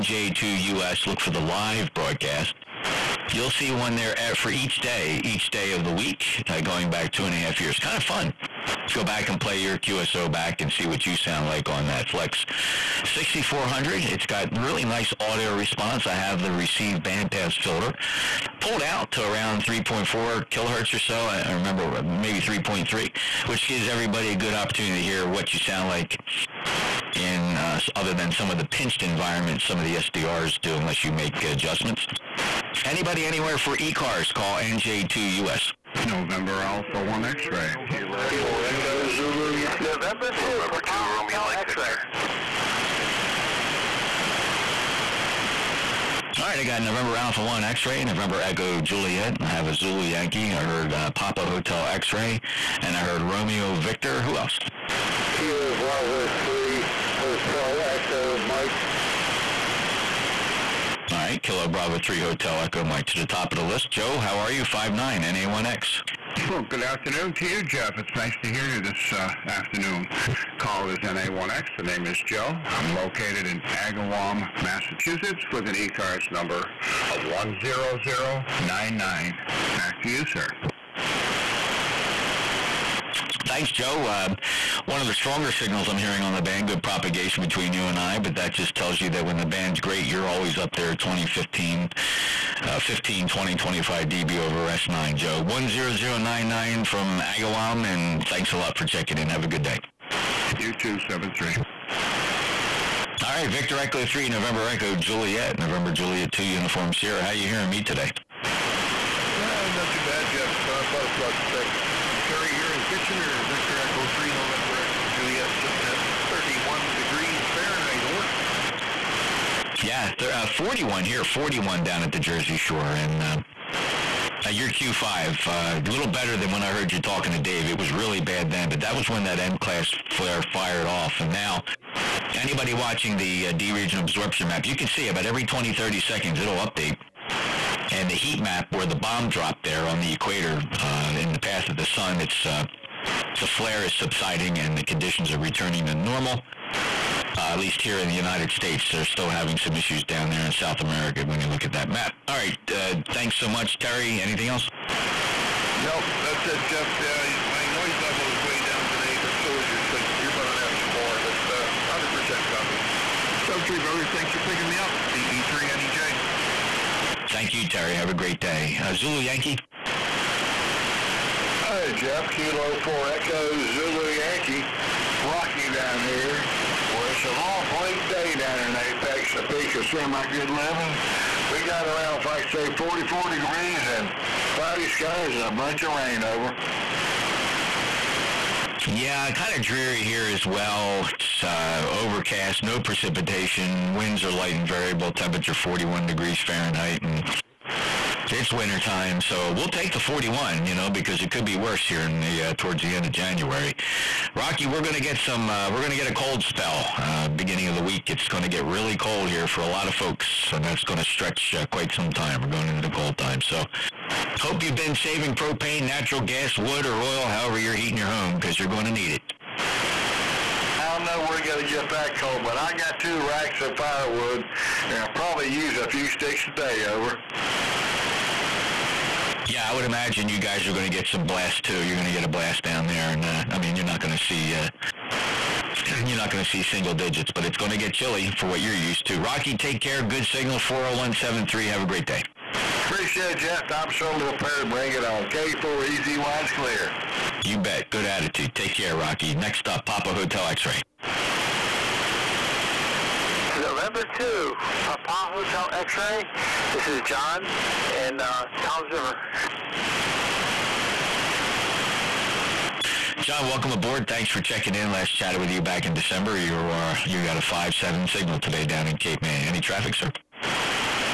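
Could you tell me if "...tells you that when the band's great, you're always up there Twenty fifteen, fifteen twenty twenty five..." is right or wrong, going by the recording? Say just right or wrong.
right.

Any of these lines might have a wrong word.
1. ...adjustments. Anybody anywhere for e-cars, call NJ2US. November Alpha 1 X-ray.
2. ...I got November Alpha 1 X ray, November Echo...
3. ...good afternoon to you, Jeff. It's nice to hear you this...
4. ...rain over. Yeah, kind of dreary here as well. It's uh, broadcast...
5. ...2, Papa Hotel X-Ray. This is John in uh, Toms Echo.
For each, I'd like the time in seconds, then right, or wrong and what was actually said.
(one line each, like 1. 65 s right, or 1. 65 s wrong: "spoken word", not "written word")
1. 31 s right
2. 46 s right
3. 66 s right
4. 185 s wrong: "overcast", not "broadcast"
5. 254 s wrong: "River", not "Echo".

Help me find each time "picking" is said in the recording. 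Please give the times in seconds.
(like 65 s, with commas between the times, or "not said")
164 s.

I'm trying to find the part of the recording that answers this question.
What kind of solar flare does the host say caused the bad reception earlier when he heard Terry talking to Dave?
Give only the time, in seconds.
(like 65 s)
129 s.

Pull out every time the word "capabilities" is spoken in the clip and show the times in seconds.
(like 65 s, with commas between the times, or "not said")
not said.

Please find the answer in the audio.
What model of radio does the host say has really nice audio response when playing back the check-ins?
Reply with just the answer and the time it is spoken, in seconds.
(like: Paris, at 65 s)
Flex 6400, at 12 s.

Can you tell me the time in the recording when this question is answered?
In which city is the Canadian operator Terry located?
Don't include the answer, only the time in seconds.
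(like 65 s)
112 s.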